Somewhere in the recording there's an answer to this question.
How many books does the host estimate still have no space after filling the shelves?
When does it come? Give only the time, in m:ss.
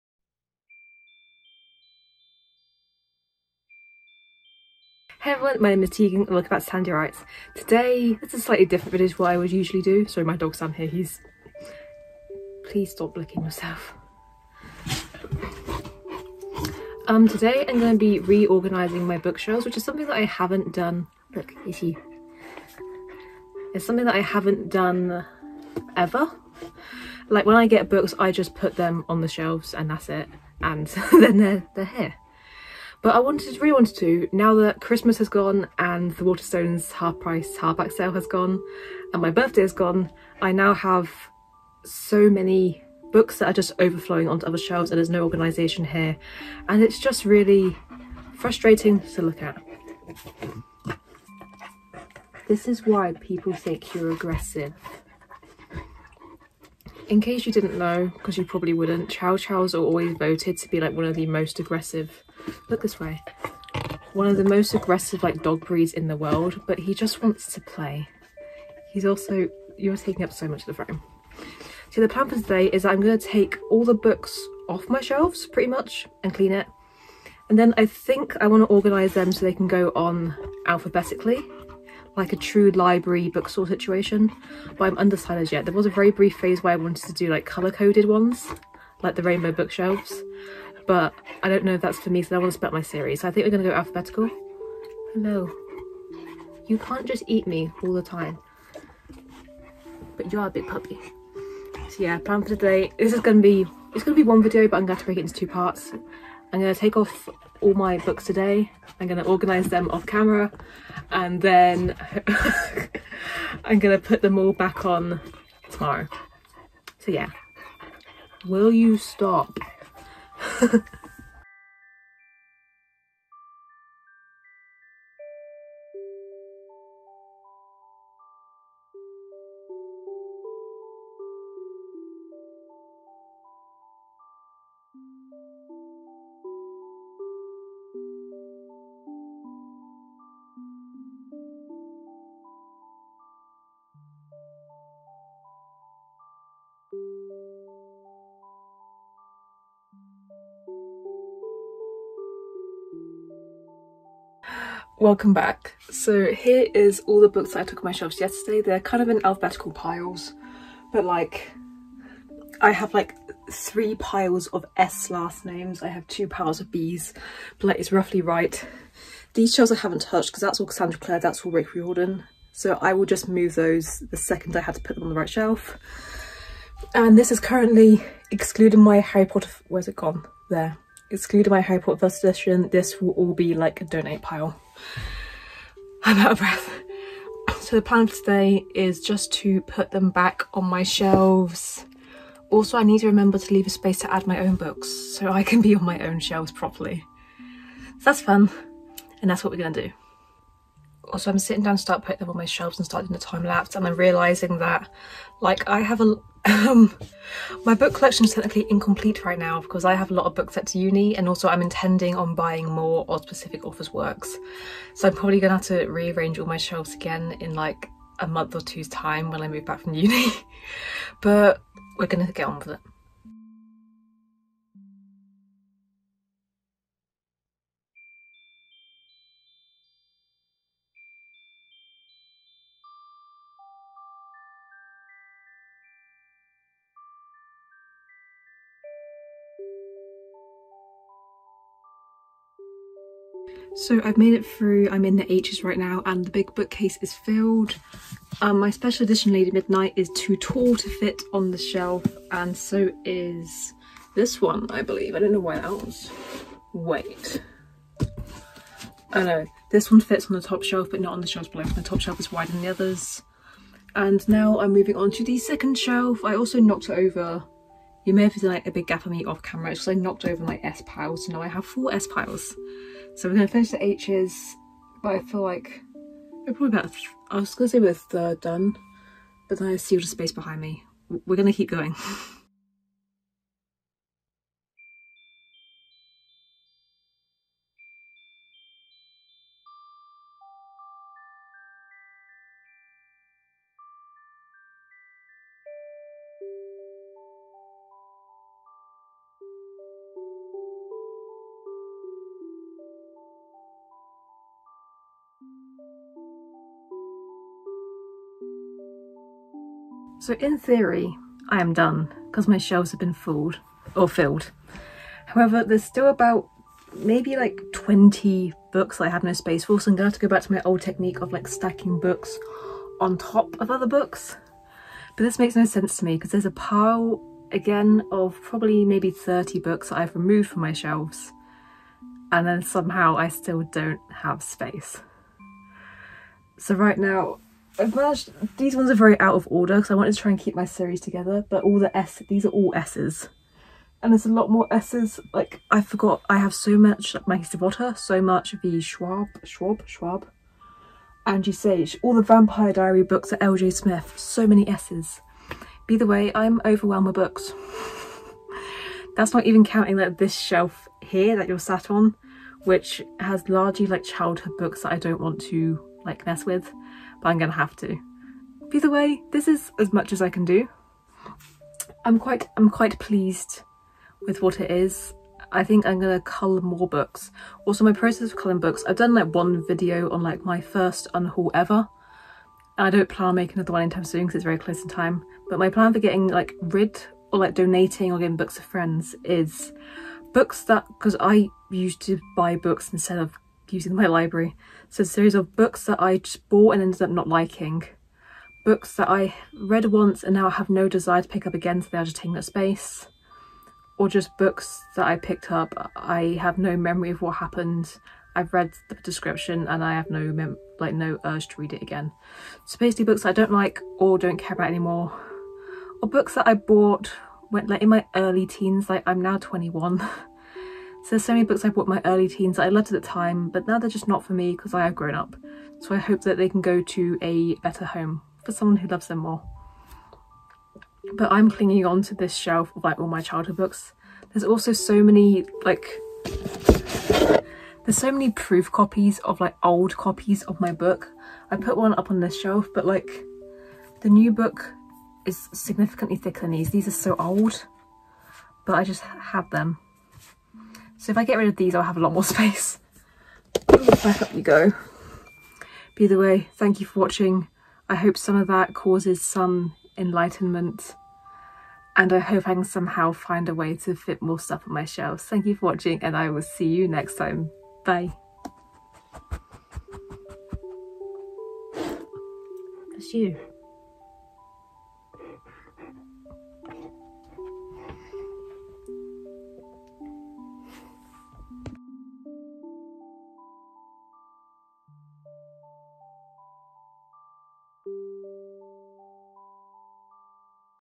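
5:17.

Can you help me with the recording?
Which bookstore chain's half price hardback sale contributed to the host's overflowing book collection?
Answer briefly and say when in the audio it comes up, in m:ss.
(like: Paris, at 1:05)
Waterstones, at 0:36.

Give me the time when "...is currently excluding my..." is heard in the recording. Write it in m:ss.
2:57.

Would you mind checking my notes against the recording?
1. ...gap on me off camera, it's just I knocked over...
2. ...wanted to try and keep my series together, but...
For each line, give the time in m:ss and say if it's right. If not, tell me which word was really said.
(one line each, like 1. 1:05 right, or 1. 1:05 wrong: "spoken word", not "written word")
1. 4:28 right
2. 5:39 right.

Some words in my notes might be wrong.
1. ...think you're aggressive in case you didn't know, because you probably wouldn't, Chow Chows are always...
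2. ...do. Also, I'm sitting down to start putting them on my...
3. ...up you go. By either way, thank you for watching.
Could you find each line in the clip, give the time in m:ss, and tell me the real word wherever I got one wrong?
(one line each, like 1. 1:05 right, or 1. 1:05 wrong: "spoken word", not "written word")
1. 0:53 right
2. 3:19 right
3. 7:34 right.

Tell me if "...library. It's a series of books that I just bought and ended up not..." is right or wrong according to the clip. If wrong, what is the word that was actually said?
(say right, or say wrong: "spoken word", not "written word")
right.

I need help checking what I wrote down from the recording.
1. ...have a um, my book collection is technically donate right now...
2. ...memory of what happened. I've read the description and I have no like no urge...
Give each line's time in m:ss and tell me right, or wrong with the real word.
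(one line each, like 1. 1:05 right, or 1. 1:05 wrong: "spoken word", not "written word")
1. 3:25 wrong: "incomplete", not "donate"
2. 6:46 right.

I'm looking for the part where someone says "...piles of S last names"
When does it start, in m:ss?
2:43.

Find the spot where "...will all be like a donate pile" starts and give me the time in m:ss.
3:03.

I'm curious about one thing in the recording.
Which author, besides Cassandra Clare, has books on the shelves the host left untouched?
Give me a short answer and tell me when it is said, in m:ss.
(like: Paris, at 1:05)
Rick Riordan, at 2:51.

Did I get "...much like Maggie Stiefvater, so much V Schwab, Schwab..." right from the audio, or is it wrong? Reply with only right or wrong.
right.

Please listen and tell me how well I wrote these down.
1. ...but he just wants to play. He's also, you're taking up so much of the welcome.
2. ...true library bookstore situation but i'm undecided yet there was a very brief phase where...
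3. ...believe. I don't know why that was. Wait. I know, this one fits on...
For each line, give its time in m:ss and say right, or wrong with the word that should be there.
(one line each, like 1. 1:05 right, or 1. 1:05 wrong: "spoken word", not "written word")
1. 1:06 wrong: "frame", not "welcome"
2. 1:22 right
3. 4:14 right.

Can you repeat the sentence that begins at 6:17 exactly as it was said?
Also my process of culling books, I've done like one video on like my first unhaul ever.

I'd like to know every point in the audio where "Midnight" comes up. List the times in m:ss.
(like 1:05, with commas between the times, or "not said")
4:09.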